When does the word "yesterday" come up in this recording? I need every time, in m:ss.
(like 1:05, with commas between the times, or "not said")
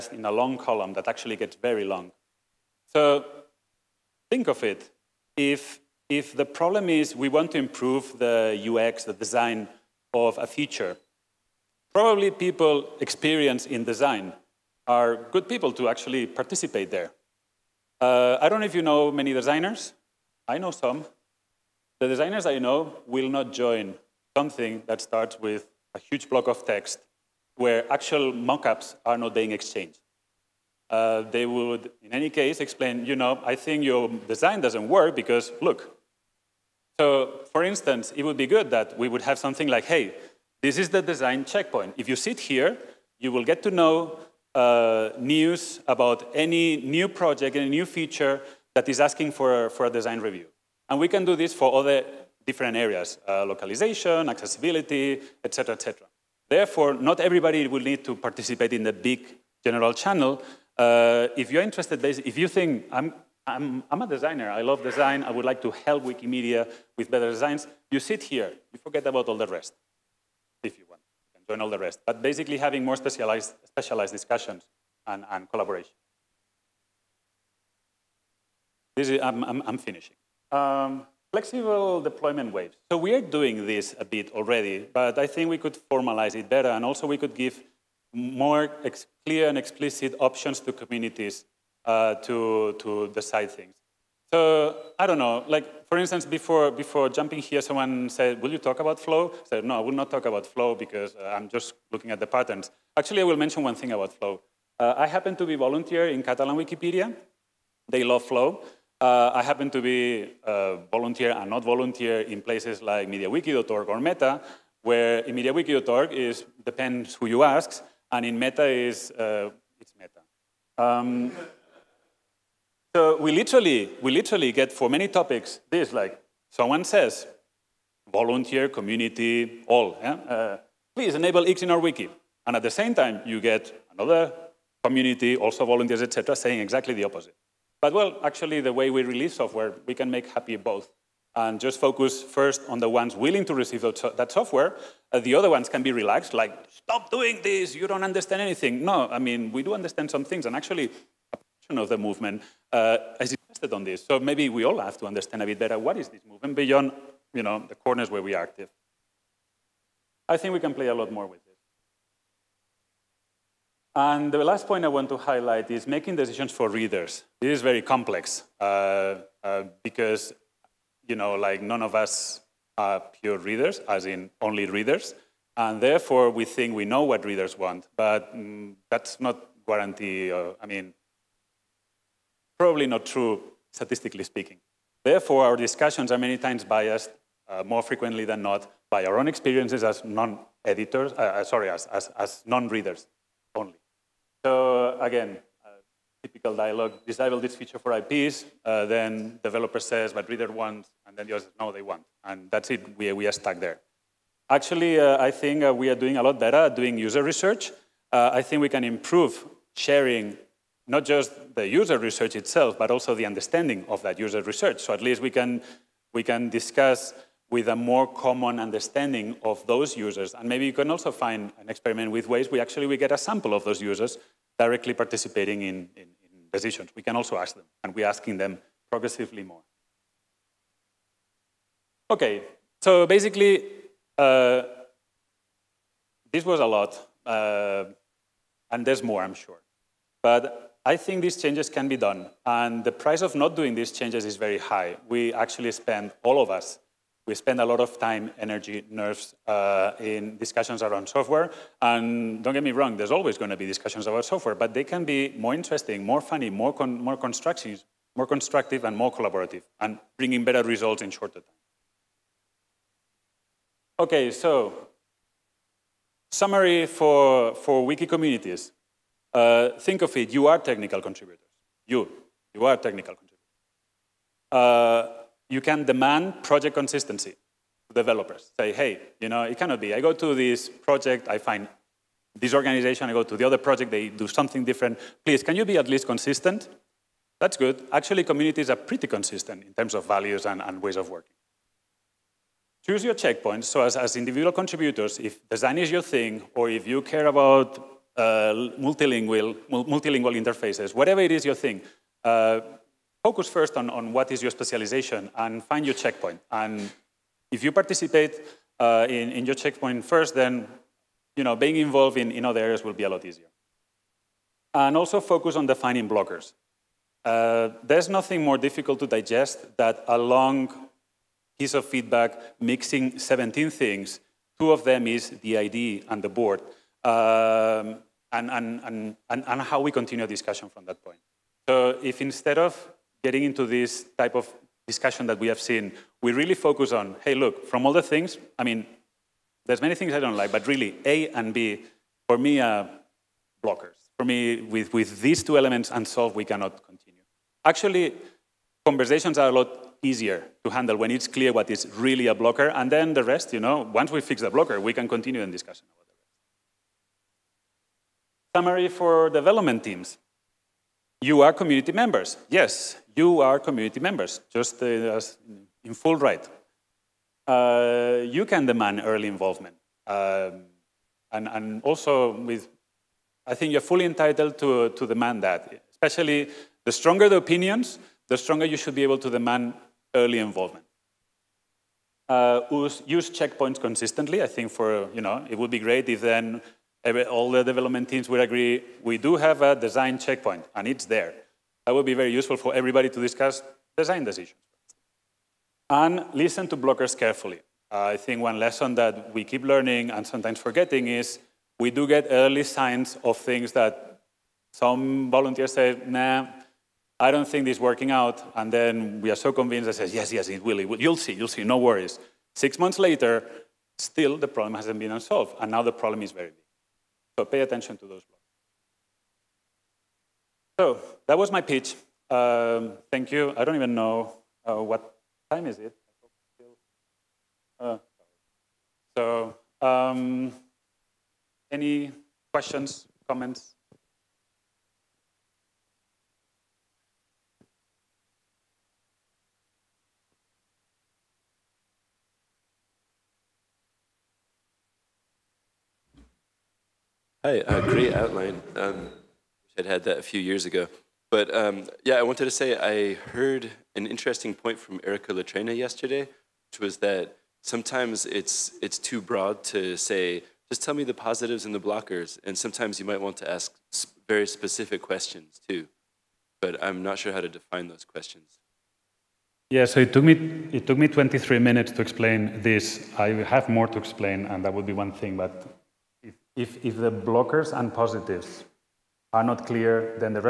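7:35.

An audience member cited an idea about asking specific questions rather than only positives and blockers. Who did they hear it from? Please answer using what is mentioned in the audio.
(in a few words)
Erica Litrenta.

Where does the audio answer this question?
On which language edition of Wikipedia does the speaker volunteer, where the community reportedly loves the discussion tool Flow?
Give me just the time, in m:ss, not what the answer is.
1:46.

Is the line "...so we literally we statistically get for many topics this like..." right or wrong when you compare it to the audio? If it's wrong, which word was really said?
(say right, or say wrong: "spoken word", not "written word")
wrong: "literally", not "statistically".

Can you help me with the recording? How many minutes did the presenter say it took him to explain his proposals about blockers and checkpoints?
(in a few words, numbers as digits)
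23.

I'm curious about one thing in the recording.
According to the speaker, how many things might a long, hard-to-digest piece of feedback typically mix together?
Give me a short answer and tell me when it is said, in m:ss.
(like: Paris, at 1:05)
17, at 5:23.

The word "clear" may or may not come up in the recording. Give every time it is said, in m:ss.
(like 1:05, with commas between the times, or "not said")
1:29, 5:51, 7:59.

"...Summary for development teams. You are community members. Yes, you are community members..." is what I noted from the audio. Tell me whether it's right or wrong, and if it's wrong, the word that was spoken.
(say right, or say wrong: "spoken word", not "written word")
right.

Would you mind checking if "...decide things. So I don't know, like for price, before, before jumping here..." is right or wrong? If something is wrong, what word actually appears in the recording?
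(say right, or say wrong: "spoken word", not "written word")
wrong: "instance", not "price".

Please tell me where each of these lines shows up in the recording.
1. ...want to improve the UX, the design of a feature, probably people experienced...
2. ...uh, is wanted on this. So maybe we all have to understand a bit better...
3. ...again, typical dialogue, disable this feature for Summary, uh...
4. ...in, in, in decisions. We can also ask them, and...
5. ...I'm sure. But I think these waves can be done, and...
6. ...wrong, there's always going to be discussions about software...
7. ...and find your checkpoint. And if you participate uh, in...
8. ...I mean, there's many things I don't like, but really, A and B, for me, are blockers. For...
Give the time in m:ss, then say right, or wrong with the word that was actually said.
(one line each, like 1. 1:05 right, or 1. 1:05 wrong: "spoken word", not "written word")
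1. 0:07 right
2. 2:32 wrong: "invested", not "wanted"
3. 3:15 wrong: "IPs", not "Summary"
4. 3:45 right
5. 3:59 wrong: "changes", not "waves"
6. 4:12 right
7. 5:05 right
8. 5:38 right.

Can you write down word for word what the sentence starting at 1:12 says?
But basically having more specialized, specialized discussions and, and collaboration.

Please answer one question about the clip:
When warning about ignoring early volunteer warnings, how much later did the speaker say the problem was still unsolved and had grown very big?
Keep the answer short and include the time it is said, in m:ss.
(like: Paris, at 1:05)
Six months, at 6:52.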